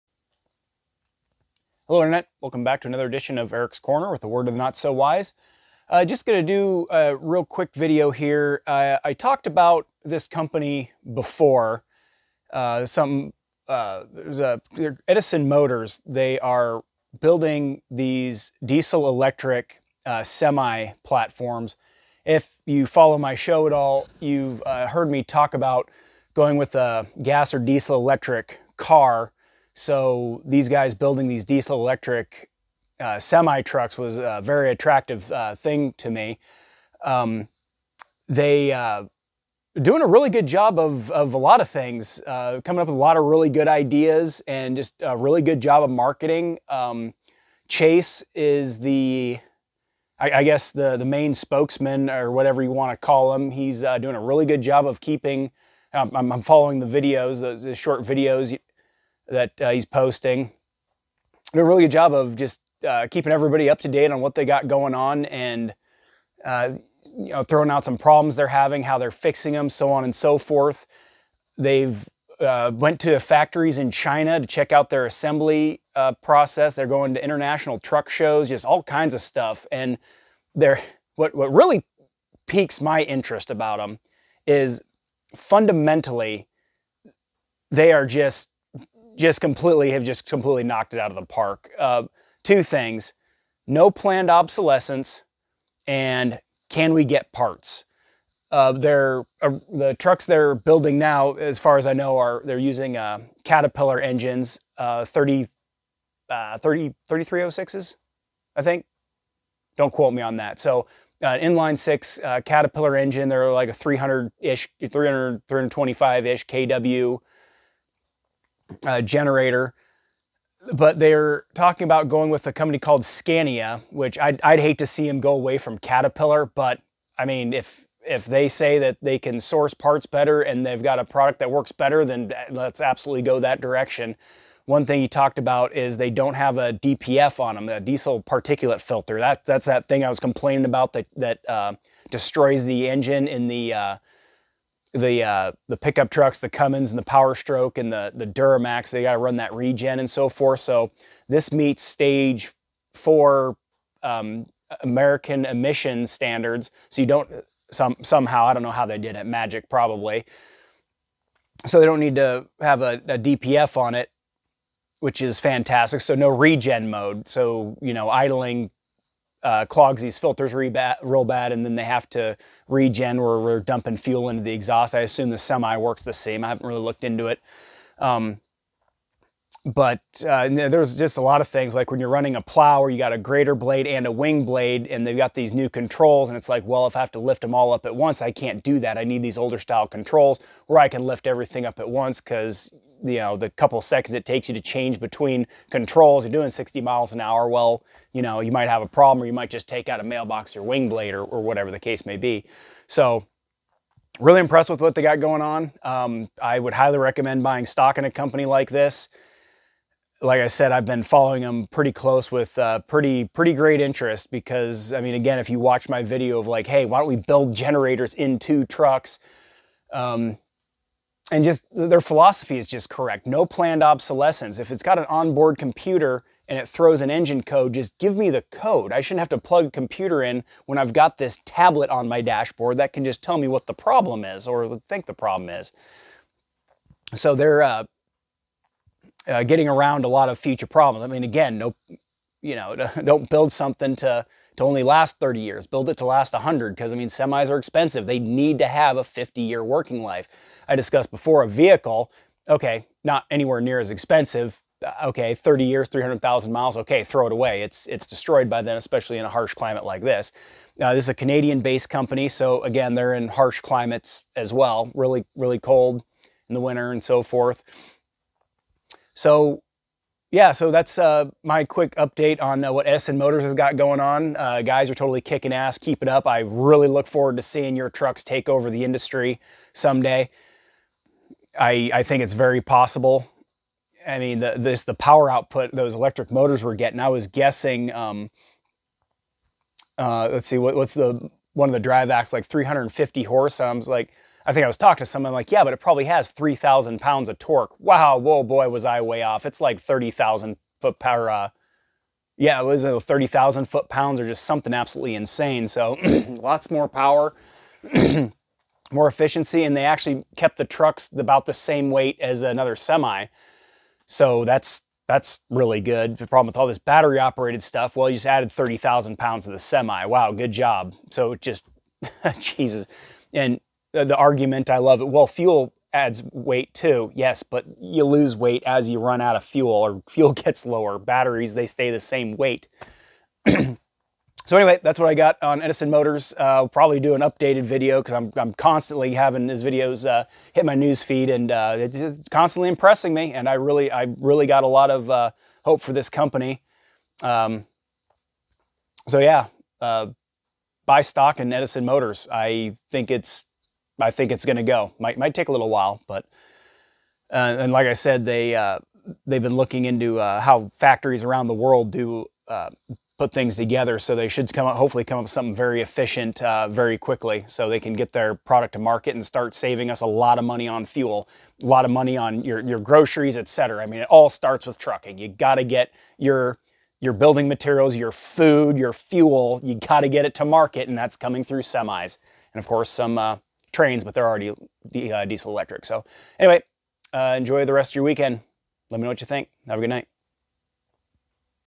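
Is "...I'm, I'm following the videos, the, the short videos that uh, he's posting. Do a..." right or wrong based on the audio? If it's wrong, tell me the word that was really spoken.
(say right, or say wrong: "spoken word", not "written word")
right.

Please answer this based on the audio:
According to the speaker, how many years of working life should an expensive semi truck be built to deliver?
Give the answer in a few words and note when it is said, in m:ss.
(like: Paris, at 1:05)
50 years, at 4:09.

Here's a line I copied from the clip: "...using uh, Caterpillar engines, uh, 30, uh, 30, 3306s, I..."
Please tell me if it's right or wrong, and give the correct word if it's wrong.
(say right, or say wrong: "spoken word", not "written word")
right.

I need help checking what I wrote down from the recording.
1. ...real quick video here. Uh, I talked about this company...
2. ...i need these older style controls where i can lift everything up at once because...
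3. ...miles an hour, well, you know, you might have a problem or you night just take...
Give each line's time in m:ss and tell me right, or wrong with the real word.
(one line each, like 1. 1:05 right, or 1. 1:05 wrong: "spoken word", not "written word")
1. 0:07 right
2. 3:08 right
3. 3:16 wrong: "might", not "night".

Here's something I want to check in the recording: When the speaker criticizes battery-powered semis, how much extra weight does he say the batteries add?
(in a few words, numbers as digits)
30,000 pounds.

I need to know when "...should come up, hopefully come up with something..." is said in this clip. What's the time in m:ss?
6:04.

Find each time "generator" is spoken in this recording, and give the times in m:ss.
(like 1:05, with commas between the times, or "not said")
1:59, 3:37.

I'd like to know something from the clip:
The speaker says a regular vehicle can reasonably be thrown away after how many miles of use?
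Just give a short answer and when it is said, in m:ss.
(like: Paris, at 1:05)
300,000 miles, at 4:15.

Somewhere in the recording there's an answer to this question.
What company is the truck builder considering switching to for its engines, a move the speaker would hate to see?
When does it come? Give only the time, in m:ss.
2:03.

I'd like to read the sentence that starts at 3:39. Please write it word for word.
Um, and just their philosophy is just correct.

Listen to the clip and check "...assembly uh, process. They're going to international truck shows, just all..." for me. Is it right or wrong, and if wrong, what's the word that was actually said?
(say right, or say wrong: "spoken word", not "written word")
right.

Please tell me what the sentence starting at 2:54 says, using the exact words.
I assume the semi works the same.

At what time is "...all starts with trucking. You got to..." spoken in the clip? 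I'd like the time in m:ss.
6:14.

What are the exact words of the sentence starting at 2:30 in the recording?
So this meets stage four um, American emission standards.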